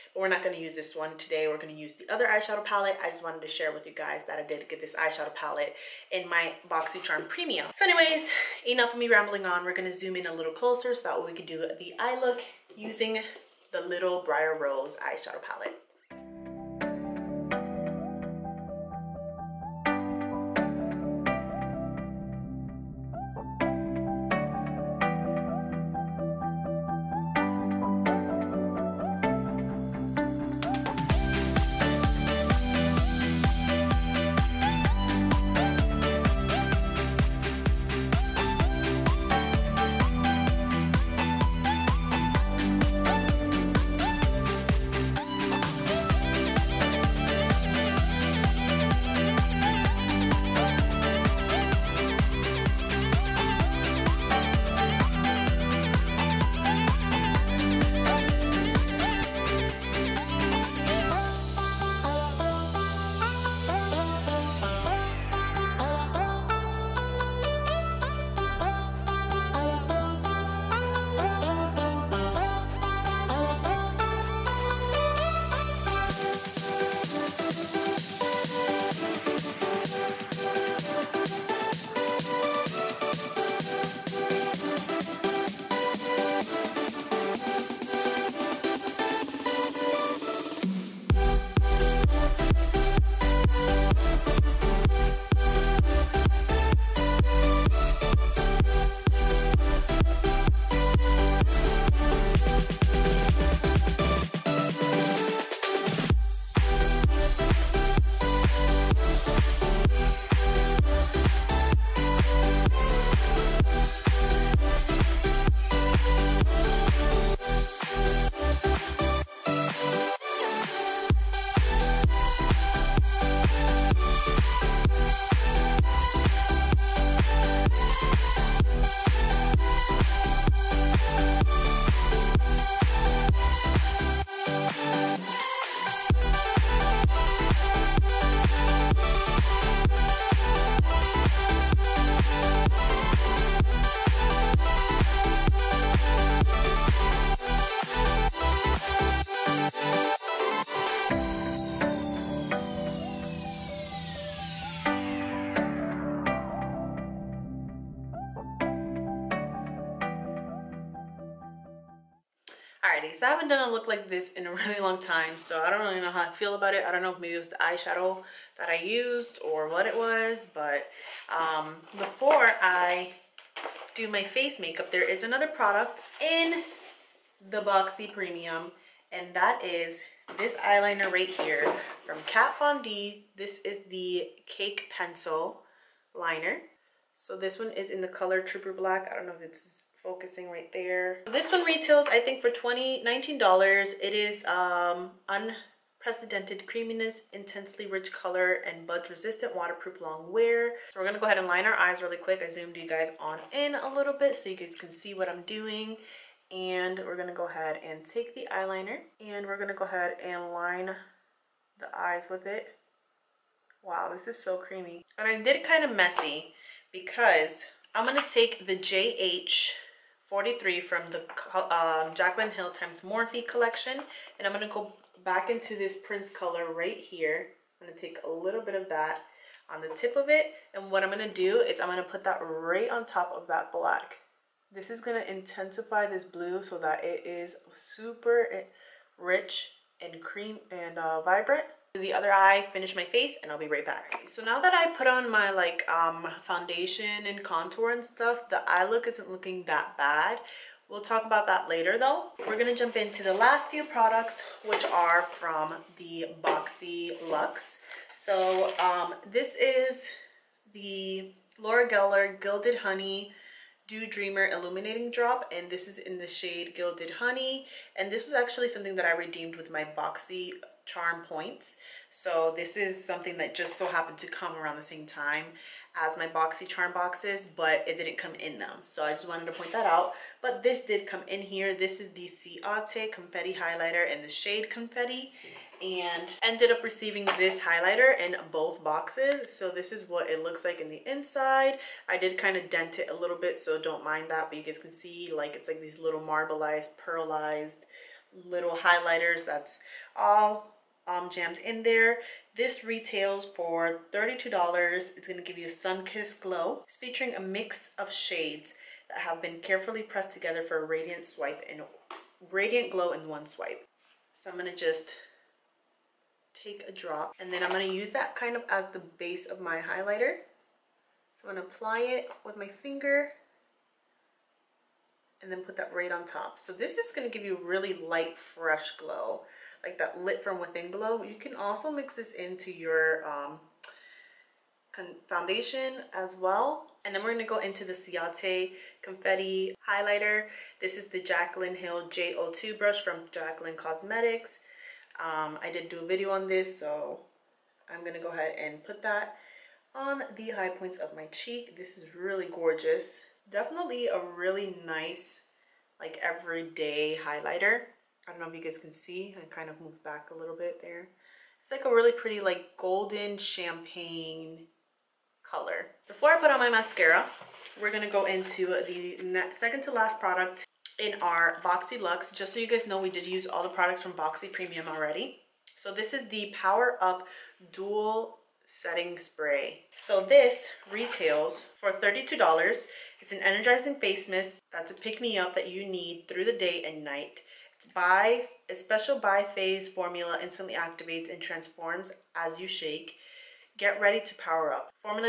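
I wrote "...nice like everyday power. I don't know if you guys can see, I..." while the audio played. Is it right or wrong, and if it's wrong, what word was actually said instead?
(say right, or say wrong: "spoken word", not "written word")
wrong: "highlighter", not "power".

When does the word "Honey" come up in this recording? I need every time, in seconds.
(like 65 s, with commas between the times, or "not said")
262 s, 267 s.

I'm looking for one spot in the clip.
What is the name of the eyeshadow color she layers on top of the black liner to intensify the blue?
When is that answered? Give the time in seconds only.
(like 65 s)
226 s.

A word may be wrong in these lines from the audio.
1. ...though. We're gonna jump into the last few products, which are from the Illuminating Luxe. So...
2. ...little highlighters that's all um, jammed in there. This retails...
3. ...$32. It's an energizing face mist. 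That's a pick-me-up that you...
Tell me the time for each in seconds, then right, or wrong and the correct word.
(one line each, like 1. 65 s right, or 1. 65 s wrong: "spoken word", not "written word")
1. 251 s wrong: "Boxy", not "Illuminating"
2. 298 s right
3. 381 s right.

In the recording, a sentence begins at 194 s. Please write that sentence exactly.
It is um, unprecedented creaminess, intensely rich color, and budge-resistant, waterproof, long wear.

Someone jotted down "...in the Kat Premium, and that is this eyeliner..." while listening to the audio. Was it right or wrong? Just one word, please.
wrong.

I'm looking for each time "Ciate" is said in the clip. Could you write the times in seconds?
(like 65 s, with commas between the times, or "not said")
282 s, 337 s.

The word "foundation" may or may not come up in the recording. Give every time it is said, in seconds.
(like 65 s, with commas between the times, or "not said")
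246 s, 335 s.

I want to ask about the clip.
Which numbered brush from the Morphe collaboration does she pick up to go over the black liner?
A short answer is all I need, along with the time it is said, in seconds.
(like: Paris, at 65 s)
JH 43, at 218 s.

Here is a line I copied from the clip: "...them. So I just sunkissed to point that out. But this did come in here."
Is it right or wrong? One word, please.
wrong.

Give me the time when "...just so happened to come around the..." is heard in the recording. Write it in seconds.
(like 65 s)
273 s.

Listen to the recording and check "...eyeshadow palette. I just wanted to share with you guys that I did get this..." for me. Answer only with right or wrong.
right.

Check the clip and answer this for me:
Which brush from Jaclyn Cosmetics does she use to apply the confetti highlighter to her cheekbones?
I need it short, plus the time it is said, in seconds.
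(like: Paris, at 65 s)
J02, at 342 s.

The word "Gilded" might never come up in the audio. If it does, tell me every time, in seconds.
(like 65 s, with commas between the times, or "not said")
262 s, 266 s.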